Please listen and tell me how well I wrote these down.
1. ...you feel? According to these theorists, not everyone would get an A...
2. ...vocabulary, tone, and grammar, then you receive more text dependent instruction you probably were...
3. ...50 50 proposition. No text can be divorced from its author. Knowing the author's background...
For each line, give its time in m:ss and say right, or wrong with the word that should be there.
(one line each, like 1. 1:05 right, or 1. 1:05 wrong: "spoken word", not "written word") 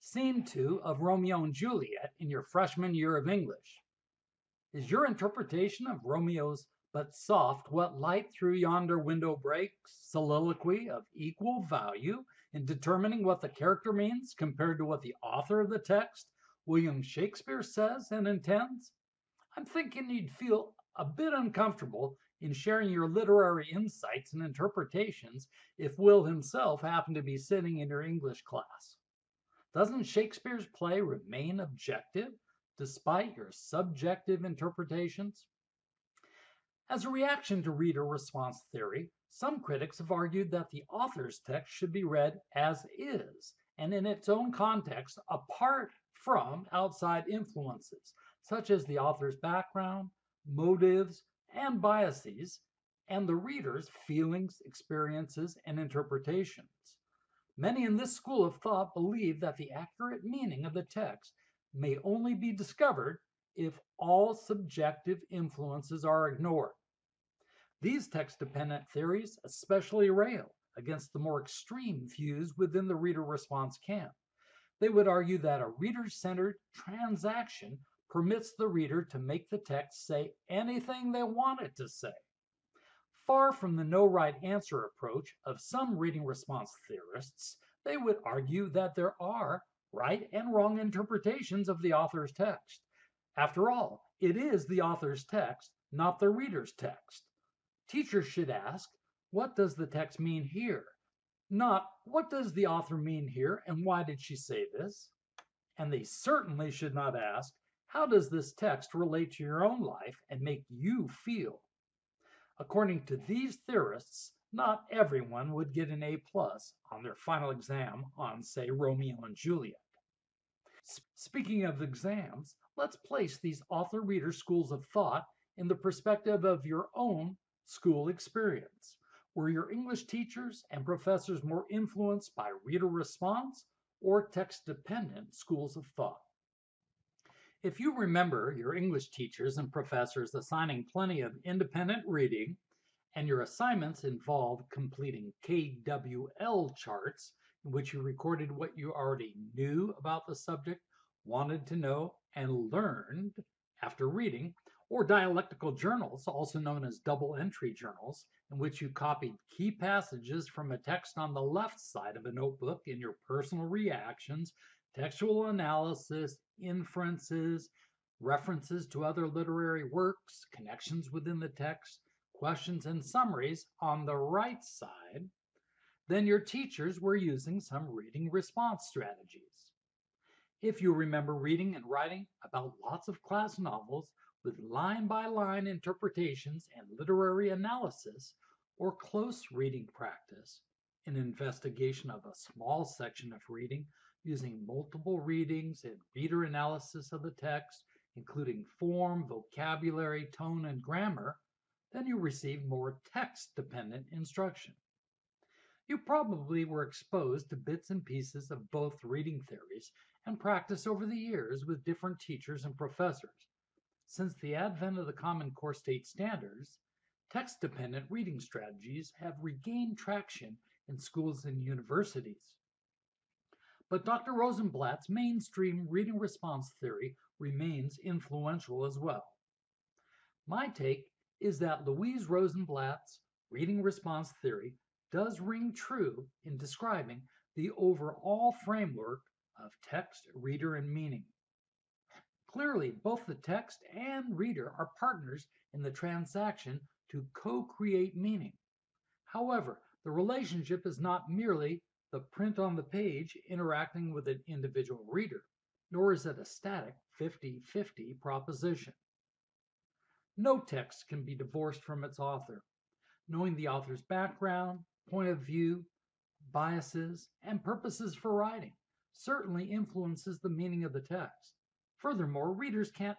1. 1:50 right
2. 3:19 right
3. 4:17 right.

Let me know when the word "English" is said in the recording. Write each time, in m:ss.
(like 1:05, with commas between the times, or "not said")
0:03, 0:28, 2:09, 2:18.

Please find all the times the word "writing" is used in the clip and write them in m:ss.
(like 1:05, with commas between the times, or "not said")
3:01, 4:28.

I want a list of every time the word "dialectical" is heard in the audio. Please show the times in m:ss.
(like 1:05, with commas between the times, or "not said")
2:35.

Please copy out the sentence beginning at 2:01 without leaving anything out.
Speaking of exams, let's place these author reader schools of thought in the perspective of your own school experience.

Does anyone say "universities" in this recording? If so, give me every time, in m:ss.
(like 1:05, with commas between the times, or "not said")
3:41.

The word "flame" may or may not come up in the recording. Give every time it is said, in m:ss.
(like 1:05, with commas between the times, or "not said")
not said.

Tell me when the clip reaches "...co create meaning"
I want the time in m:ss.
4:07.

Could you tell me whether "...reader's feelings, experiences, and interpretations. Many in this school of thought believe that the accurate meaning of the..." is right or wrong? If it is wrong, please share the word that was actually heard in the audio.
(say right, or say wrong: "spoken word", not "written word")
right.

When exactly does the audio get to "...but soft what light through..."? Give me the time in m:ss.
0:06.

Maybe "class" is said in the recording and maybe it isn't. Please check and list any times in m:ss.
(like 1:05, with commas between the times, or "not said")
0:28, 3:03.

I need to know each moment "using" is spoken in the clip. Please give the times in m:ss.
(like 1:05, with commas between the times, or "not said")
2:57, 3:14.